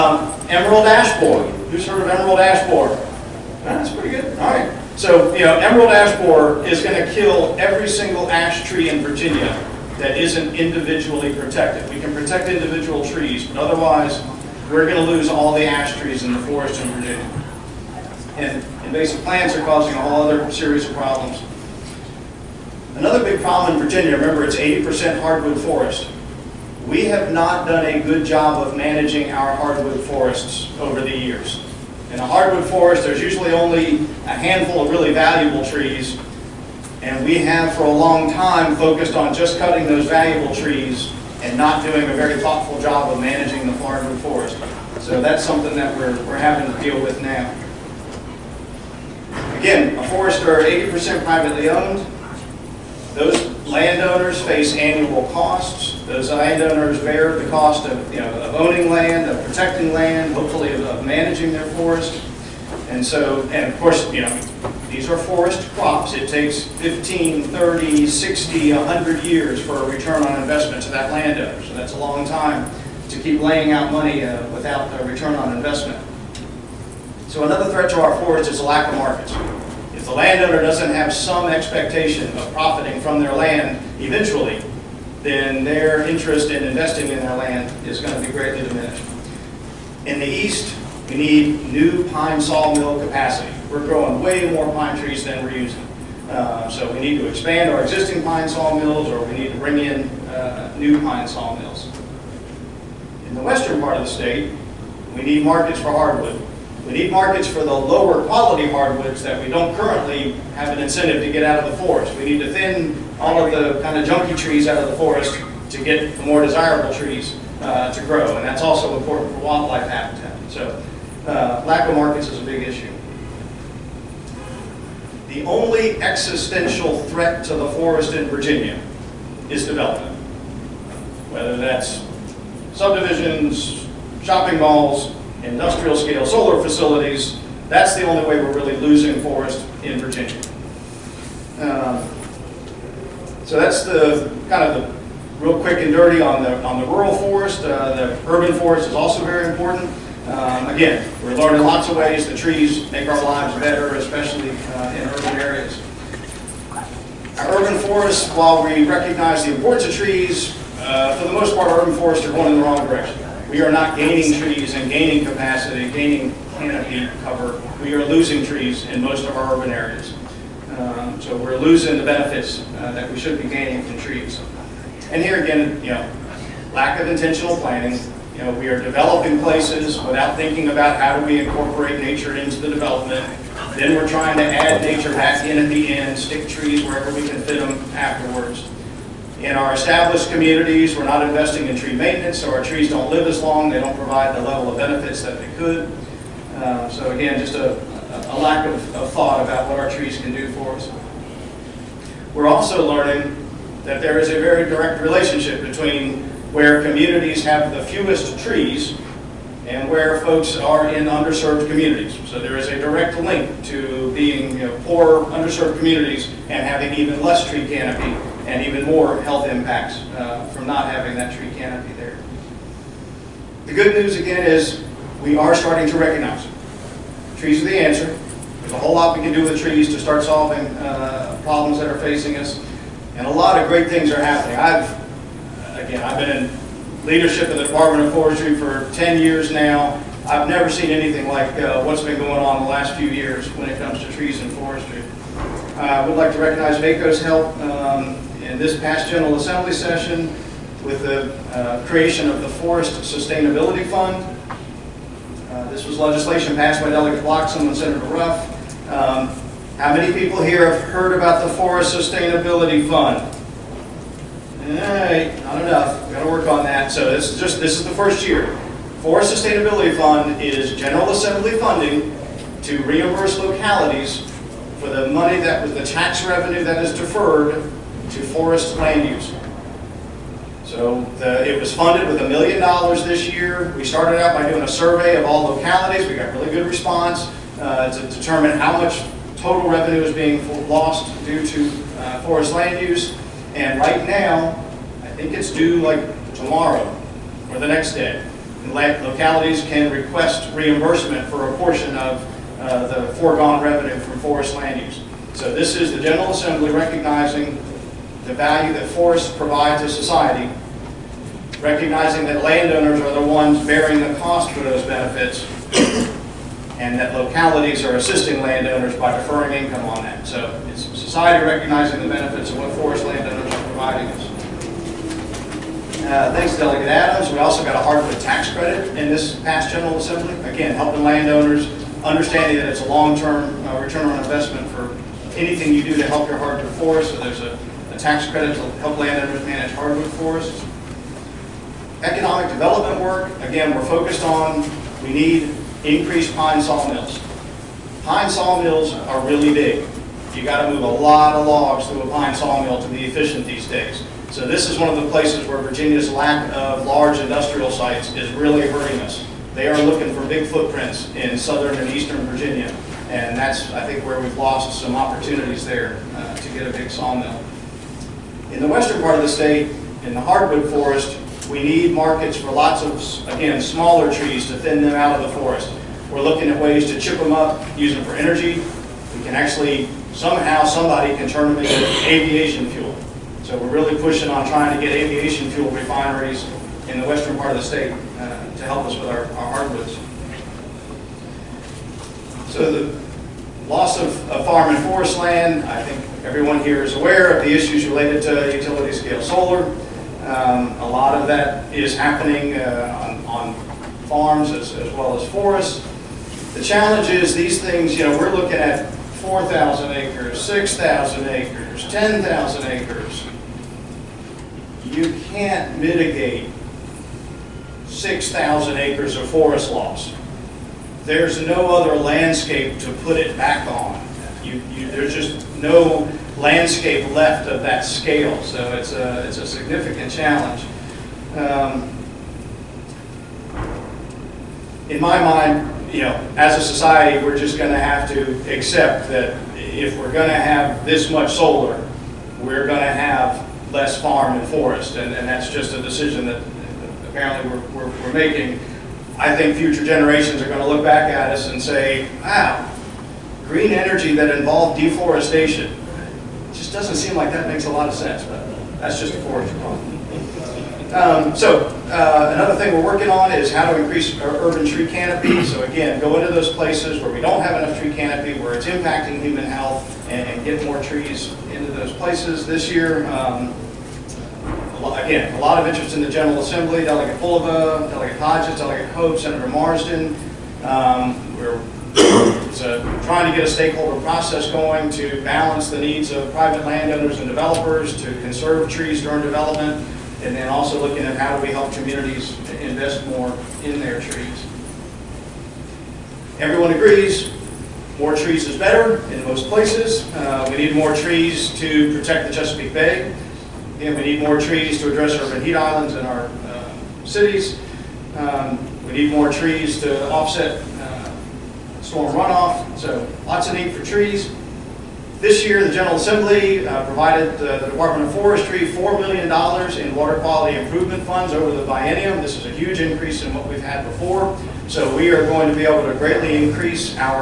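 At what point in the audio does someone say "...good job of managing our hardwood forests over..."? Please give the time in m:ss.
0:27.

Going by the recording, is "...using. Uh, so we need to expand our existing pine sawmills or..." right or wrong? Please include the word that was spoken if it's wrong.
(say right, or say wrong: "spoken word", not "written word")
right.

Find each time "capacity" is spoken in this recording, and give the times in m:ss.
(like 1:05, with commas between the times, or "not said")
1:33, 2:45.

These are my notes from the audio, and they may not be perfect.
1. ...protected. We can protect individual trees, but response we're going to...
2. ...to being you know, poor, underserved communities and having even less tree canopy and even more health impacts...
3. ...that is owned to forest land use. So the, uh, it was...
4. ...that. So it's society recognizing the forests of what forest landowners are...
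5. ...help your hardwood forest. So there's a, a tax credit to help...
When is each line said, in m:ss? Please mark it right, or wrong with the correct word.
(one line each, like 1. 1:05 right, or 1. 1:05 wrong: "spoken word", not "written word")
1. 0:11 wrong: "otherwise", not "response"
2. 3:33 right
3. 4:36 wrong: "deferred", not "owned"
4. 5:20 wrong: "benefits", not "forests"
5. 5:36 right.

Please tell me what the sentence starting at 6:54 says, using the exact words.
You can't mitigate 6,000 acres of forest loss.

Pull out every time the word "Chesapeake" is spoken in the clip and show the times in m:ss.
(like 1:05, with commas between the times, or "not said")
8:22.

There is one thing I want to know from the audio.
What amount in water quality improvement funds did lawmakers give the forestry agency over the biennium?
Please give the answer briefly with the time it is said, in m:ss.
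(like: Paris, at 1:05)
$4 million, at 8:38.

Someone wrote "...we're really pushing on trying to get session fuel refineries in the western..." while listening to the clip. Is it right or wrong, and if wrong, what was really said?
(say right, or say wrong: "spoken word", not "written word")
wrong: "aviation", not "session".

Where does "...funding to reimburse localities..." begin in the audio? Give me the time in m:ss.
4:31.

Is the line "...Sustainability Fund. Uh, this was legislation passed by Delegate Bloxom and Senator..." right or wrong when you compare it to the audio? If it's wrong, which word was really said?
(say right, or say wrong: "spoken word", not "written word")
right.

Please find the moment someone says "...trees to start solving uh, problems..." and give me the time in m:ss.
3:49.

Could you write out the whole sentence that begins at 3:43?
The good news again is we are starting to recognize it.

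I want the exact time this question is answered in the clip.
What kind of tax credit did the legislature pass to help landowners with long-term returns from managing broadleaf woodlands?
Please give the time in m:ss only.
5:27.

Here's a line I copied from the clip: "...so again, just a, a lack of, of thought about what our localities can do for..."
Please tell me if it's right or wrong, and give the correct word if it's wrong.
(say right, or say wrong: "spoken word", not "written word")
wrong: "trees", not "localities".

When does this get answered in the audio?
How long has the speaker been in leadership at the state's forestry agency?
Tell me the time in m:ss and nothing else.
3:58.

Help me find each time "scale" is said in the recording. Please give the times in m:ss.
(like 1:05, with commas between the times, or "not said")
2:15, 6:38, 7:07.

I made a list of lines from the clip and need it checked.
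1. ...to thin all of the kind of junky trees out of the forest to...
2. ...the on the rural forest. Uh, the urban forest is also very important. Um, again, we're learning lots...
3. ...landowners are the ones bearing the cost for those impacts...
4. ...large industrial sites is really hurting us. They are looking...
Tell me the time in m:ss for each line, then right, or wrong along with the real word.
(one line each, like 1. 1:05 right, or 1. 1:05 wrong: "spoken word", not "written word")
1. 1:52 right
2. 2:26 right
3. 5:12 wrong: "benefits", not "impacts"
4. 5:56 right.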